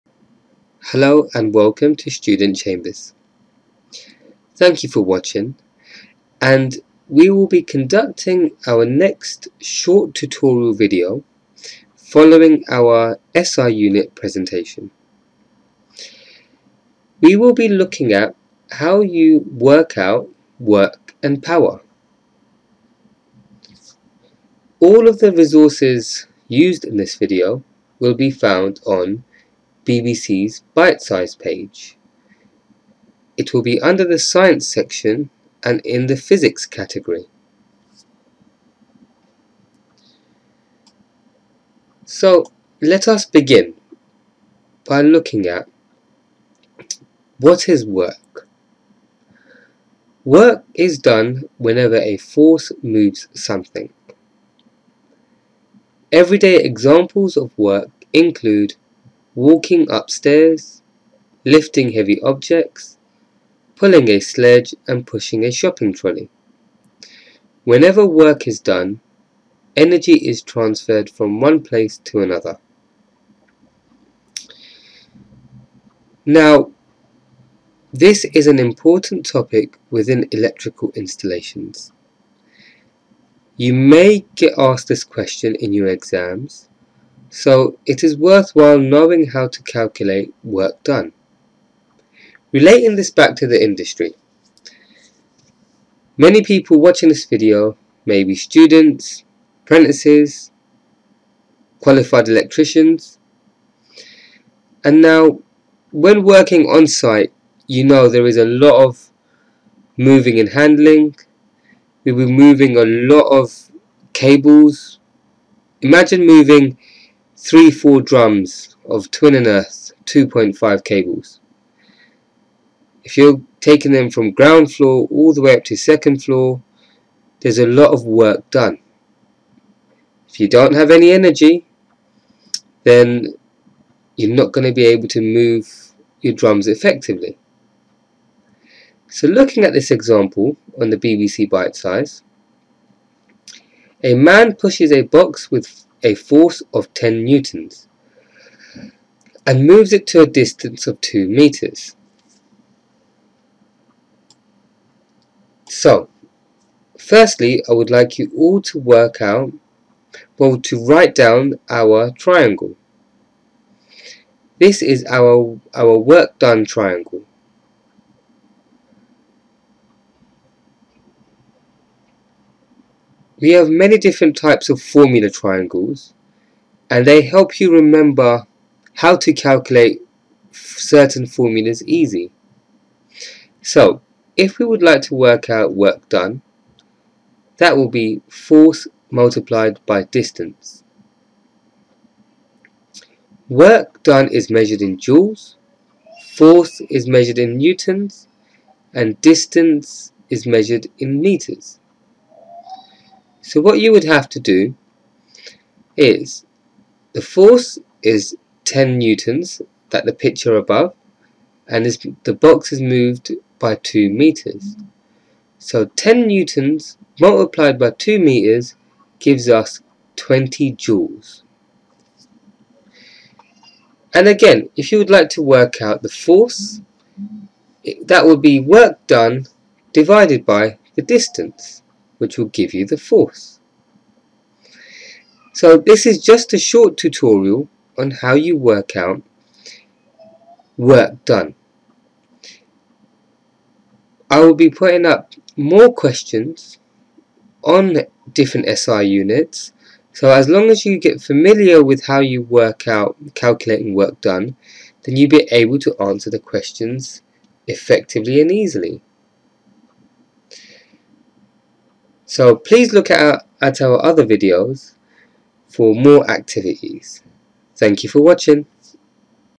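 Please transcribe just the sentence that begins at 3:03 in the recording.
So if we would like to work out work done that will be force multiplied by distance.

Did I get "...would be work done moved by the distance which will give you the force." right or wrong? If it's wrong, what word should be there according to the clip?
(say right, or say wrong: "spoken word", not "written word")
wrong: "divided", not "moved".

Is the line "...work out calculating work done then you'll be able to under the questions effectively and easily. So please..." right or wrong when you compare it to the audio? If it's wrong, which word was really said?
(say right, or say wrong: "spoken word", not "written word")
wrong: "answer", not "under".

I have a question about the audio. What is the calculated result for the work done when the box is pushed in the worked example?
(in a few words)
20 joules.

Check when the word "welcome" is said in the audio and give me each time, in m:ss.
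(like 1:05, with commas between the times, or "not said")
0:01.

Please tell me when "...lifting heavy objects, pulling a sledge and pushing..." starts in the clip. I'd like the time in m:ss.
1:01.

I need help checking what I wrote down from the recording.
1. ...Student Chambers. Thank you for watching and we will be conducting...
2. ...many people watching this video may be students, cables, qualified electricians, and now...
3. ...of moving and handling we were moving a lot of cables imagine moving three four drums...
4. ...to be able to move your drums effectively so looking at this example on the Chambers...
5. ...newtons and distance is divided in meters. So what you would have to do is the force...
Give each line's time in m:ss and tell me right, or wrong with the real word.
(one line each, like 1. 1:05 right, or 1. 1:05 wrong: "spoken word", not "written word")
1. 0:02 right
2. 1:36 wrong: "apprentices", not "cables"
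3. 1:48 right
4. 2:14 wrong: "BBC", not "Chambers"
5. 3:17 wrong: "measured", not "divided".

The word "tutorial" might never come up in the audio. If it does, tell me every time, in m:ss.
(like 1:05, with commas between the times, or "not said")
0:10, 3:56.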